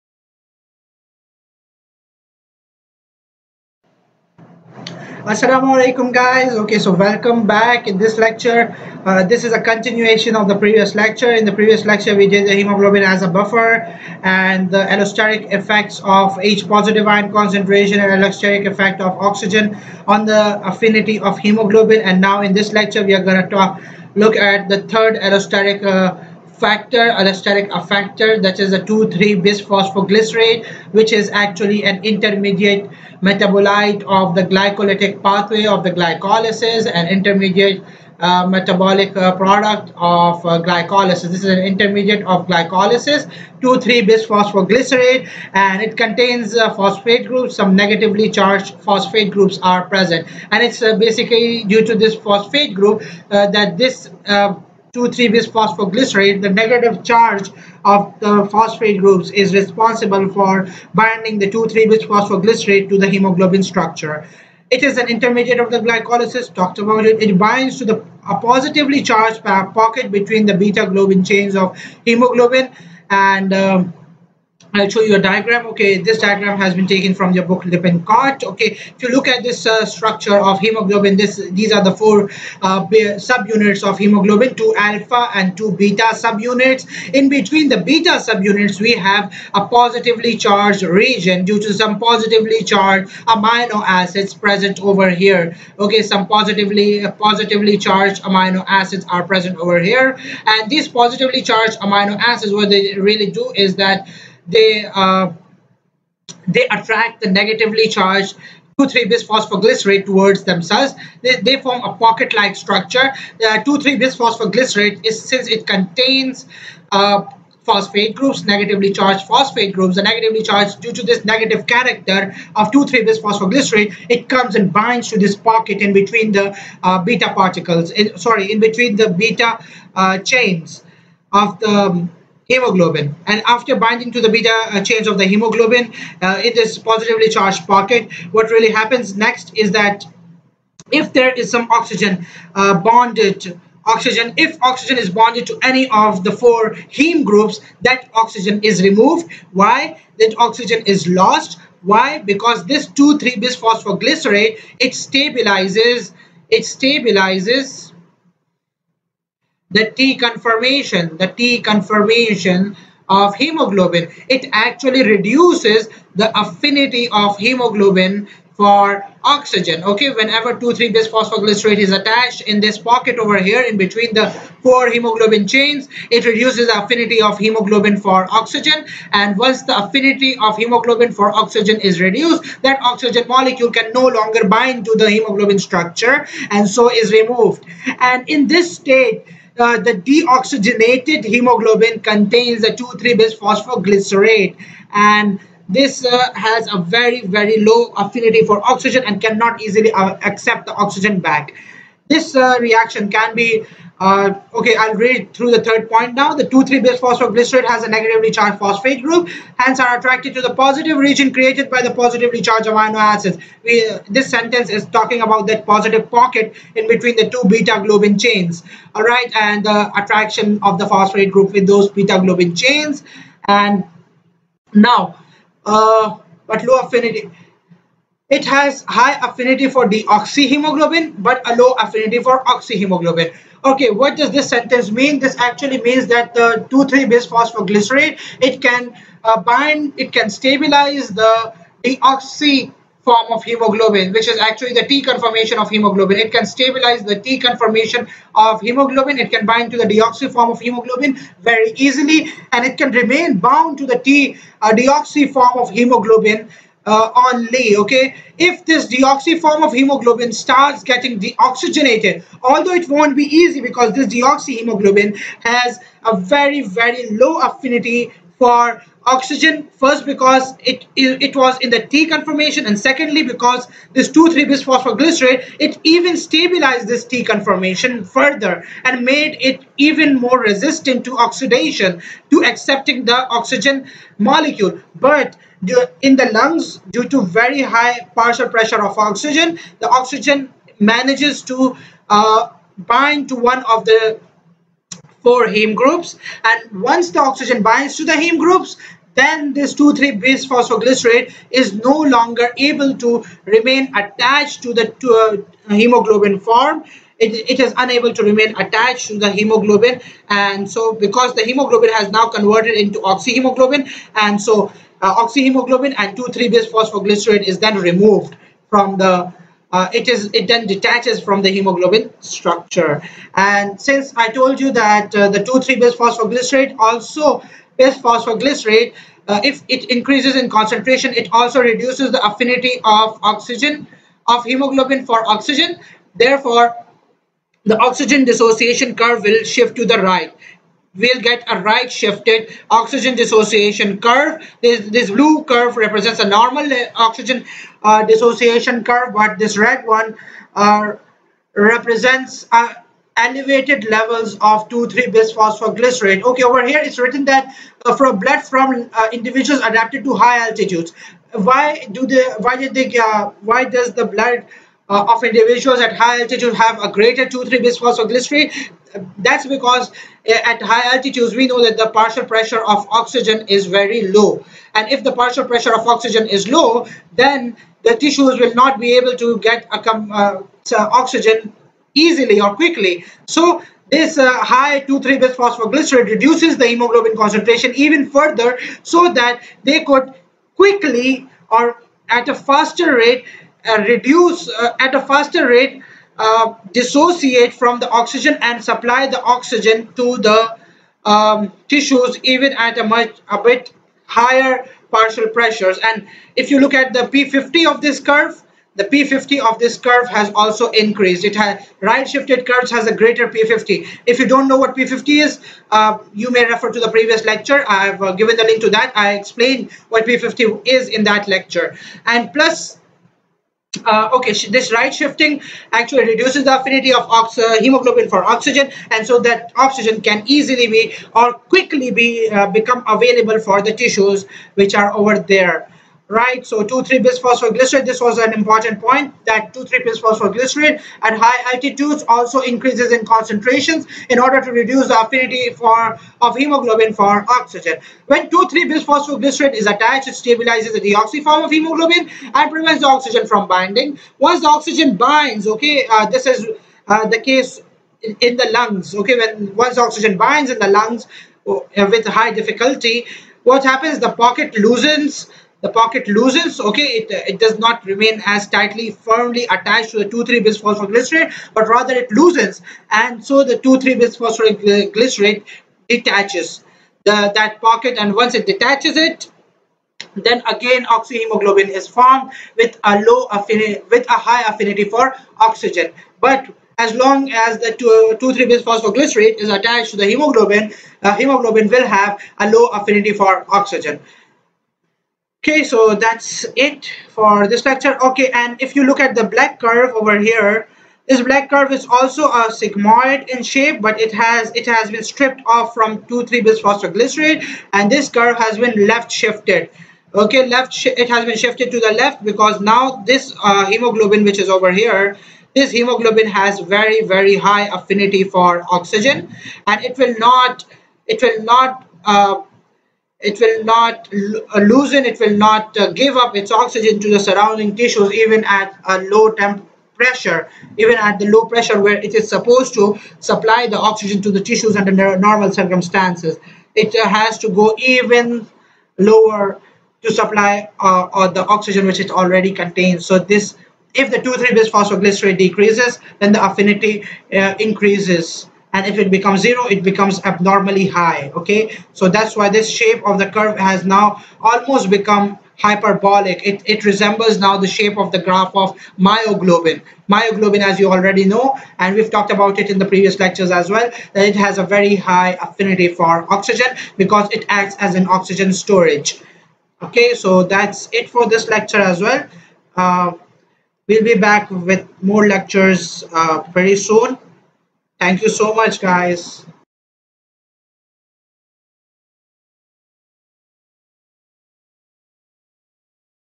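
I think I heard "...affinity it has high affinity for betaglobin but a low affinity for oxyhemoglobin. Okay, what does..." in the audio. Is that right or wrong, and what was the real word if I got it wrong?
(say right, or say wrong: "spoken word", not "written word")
wrong: "deoxyhemoglobin", not "betaglobin".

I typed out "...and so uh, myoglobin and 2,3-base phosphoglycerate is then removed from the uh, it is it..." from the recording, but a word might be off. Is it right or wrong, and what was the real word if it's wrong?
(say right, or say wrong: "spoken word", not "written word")
wrong: "oxyhemoglobin", not "myoglobin".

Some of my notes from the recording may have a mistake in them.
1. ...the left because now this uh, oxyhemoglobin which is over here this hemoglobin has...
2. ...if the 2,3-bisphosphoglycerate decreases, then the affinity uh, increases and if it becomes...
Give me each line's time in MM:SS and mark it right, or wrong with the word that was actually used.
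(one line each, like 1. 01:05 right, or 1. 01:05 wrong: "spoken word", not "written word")
1. 08:31 wrong: "hemoglobin", not "oxyhemoglobin"
2. 09:03 right.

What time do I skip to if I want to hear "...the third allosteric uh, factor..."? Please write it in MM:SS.
00:24.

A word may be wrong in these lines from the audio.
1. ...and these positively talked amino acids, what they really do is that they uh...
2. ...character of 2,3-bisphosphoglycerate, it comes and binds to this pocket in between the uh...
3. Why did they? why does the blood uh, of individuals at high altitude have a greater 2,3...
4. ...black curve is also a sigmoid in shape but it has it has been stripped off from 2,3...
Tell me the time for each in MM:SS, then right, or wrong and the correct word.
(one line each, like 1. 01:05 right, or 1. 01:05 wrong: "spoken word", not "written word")
1. 01:40 wrong: "charged", not "talked"
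2. 02:01 right
3. 06:02 right
4. 08:21 right.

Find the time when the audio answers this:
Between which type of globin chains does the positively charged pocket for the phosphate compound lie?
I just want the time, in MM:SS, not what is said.
01:10.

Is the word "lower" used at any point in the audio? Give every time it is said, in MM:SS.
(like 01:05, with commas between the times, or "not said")
08:58.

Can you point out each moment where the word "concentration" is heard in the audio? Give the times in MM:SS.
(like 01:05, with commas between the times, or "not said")
00:17, 05:30, 06:27, 07:23.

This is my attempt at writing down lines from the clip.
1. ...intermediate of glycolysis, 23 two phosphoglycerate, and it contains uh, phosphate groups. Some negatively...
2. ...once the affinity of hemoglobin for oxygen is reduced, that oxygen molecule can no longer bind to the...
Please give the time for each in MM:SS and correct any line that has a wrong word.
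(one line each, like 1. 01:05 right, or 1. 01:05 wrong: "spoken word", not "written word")
1. 00:41 wrong: "three", not "two"
2. 02:59 right.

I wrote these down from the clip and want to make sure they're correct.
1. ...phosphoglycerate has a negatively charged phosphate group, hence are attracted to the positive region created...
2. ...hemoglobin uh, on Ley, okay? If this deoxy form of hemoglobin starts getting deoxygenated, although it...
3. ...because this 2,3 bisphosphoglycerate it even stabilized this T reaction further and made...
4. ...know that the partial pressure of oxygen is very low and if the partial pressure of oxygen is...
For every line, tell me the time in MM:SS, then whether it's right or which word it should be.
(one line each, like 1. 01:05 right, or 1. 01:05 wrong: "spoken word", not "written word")
1. 03:26 right
2. 04:15 right
3. 04:33 wrong: "conformation", not "reaction"
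4. 06:11 right.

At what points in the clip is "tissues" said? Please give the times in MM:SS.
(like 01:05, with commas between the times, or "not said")
06:17, 06:41, 07:13, 08:47, 08:54.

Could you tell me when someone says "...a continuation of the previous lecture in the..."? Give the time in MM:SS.
00:09.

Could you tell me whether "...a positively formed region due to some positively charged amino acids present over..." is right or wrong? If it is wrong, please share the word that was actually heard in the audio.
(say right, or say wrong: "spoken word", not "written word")
wrong: "charged", not "formed".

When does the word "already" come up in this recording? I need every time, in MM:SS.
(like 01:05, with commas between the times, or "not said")
09:02, 09:20.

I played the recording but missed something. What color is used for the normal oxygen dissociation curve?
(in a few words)
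Blue.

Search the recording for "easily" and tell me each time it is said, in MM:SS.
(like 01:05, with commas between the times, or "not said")
03:19, 04:11, 06:21, 07:10.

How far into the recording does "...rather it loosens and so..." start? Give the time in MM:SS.
07:51.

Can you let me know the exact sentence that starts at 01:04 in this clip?
It is an intermediate of the glycolysis, talked about it.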